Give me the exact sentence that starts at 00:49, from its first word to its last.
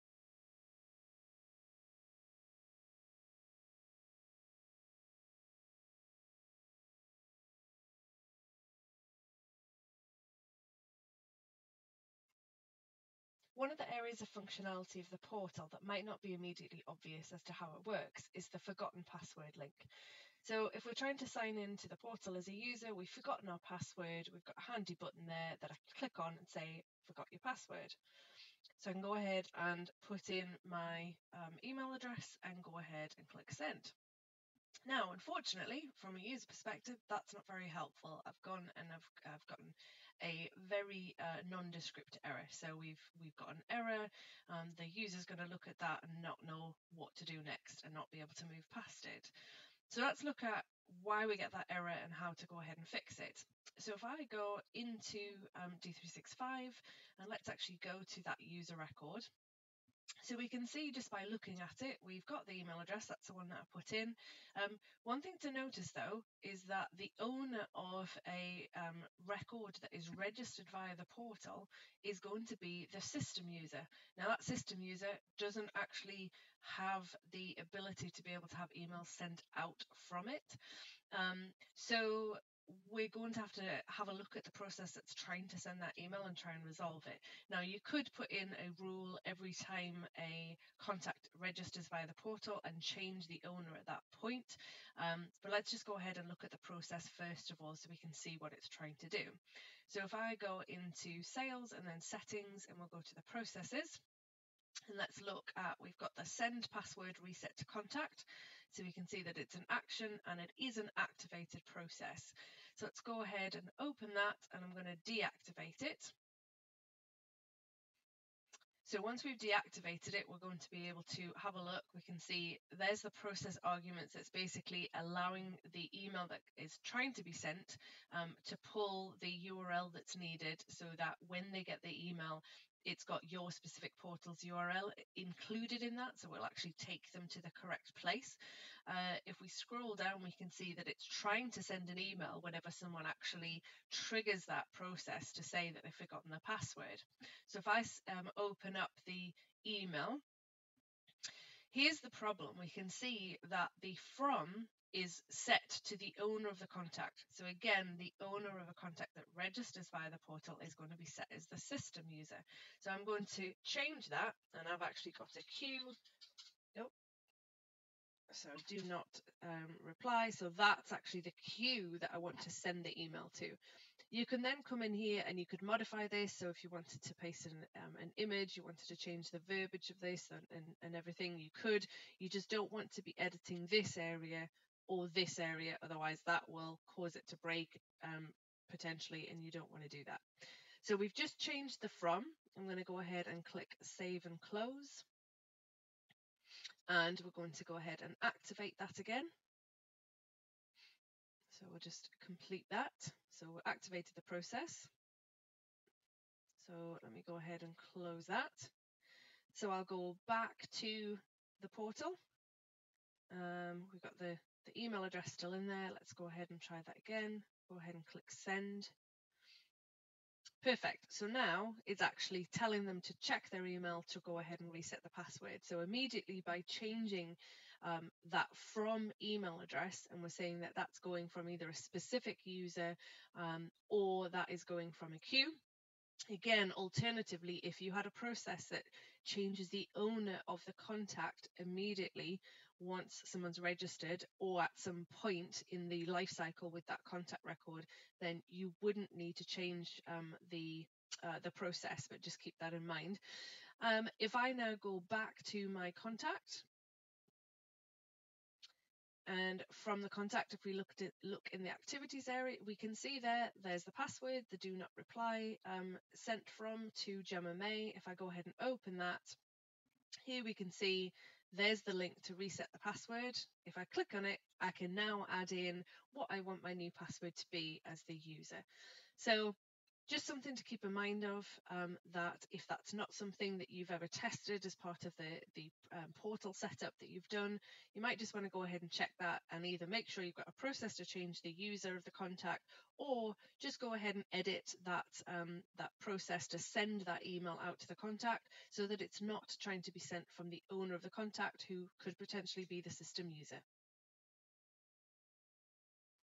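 So let's look at why we get that error and how to go ahead and fix it.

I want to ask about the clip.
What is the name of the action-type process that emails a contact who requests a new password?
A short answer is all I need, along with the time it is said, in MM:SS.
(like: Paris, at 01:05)
send password reset to contact, at 01:46.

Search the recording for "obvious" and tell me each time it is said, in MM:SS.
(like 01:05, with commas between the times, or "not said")
00:16.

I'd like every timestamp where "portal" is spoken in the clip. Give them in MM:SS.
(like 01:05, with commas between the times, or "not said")
00:15, 00:21, 01:11, 01:32, 02:14, 02:40, 03:31, 04:46.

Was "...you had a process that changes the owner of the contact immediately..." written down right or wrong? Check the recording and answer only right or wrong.
right.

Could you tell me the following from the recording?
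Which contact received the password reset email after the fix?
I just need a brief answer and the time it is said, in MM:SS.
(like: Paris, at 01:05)
Gemma May, at 04:27.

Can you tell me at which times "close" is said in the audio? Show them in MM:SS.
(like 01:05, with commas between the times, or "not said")
03:14, 03:27.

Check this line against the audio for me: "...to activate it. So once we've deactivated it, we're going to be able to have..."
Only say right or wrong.
wrong.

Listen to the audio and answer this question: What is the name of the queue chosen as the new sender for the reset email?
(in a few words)
do not reply.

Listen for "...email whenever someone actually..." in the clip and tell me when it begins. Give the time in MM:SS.
02:22.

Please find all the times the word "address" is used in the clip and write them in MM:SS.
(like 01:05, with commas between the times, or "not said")
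00:31, 01:02, 03:35, 03:49.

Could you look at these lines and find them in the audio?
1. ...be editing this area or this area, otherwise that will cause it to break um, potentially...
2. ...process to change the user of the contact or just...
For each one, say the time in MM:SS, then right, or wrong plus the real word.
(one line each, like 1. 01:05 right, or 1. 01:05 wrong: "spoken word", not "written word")
1. 03:03 right
2. 04:50 right.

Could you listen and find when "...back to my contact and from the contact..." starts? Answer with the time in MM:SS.
04:15.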